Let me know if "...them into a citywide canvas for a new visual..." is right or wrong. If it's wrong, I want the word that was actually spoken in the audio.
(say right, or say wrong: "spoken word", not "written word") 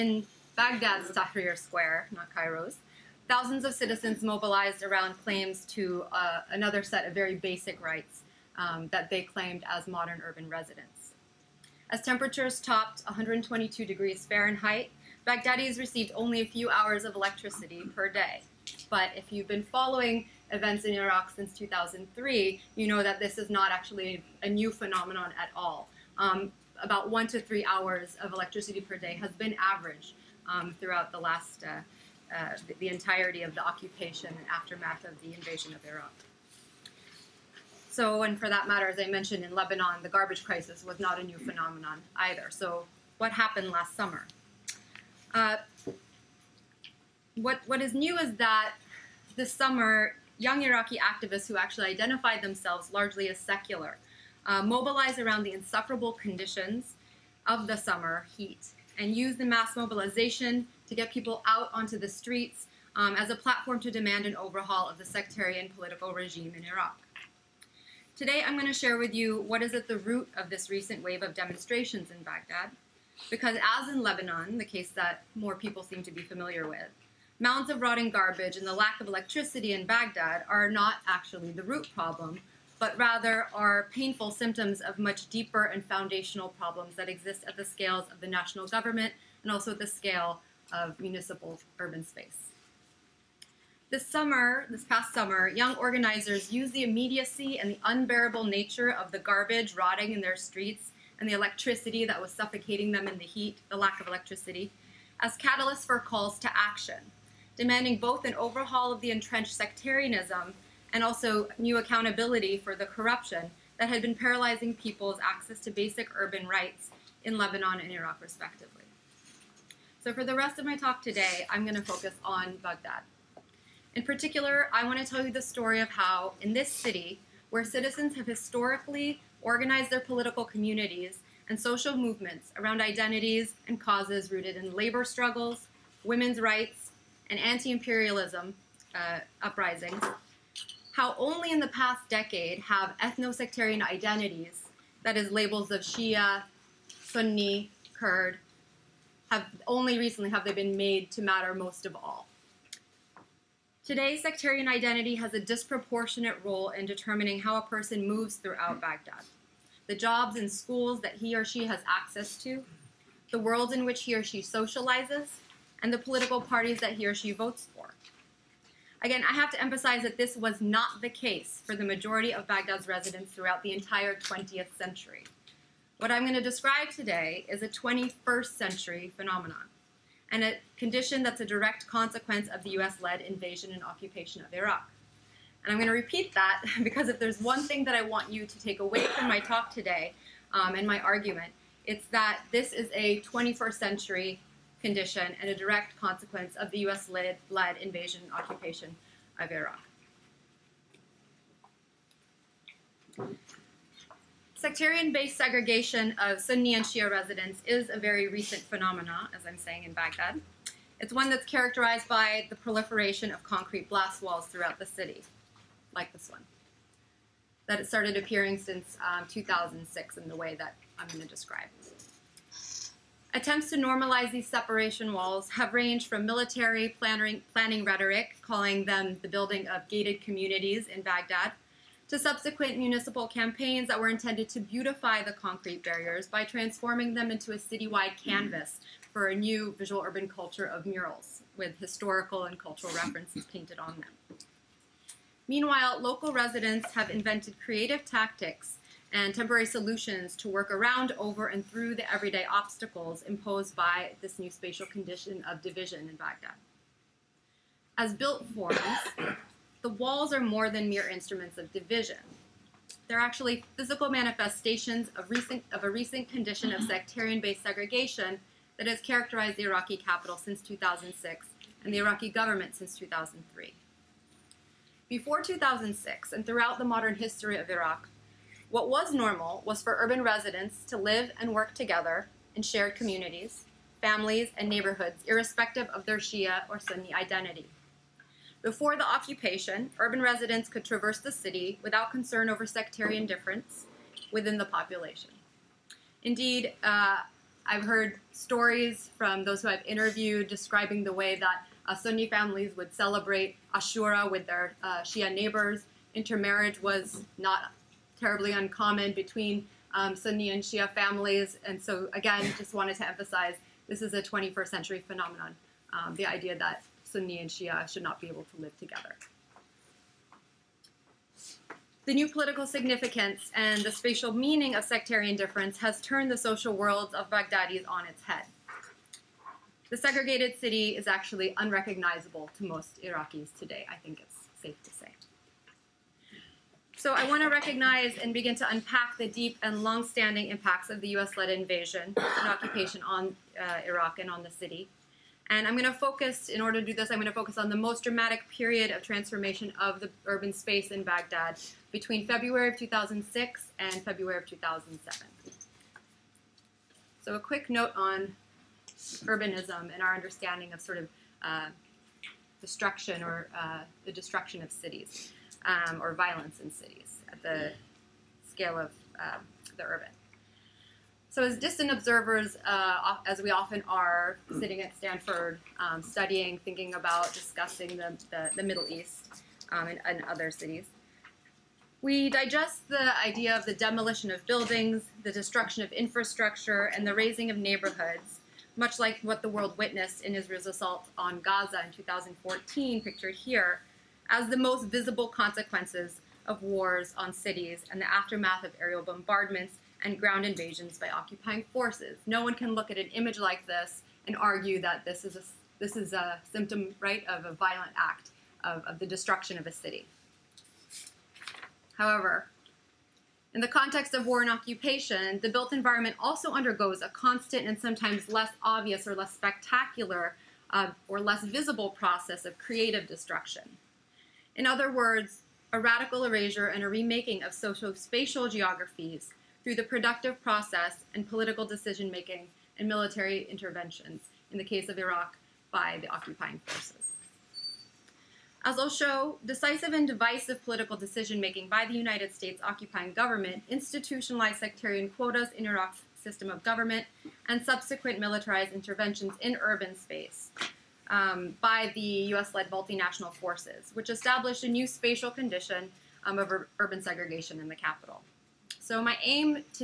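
right.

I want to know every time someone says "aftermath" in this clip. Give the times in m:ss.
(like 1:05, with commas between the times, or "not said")
0:34, 6:38.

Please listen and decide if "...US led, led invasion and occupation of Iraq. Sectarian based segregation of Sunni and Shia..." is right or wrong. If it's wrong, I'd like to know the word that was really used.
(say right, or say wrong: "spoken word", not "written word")
right.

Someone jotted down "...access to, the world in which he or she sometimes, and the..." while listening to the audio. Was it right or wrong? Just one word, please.
wrong.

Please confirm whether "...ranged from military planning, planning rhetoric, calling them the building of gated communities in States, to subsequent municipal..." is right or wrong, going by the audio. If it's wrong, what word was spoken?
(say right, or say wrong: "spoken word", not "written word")
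wrong: "Baghdad", not "States".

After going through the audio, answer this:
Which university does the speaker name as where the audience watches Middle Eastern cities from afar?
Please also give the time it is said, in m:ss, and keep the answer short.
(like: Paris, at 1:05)
Stanford, at 6:14.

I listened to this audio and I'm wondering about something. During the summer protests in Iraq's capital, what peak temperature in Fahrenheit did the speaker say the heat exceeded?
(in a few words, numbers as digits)
122 degrees.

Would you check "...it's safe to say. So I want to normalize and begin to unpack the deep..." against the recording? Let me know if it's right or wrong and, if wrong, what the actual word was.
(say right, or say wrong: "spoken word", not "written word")
wrong: "recognize", not "normalize".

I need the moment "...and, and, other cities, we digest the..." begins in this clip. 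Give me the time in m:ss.
6:19.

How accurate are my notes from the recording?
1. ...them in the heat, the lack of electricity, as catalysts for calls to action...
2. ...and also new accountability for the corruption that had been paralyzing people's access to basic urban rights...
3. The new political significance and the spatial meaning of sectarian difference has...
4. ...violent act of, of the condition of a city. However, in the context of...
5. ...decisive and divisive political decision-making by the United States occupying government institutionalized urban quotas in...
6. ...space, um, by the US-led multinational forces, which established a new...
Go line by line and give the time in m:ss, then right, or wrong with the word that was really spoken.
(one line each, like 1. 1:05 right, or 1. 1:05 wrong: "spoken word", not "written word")
1. 1:42 right
2. 1:50 right
3. 5:22 right
4. 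6:47 wrong: "destruction", not "condition"
5. 7:19 wrong: "sectarian", not "urban"
6. 7:29 right.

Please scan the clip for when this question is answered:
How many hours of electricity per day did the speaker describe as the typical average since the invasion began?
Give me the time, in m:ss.
0:27.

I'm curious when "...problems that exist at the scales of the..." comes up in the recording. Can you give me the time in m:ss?
1:26.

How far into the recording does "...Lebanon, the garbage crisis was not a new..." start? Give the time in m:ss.
0:39.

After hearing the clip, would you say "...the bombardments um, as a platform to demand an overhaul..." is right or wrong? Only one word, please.
wrong.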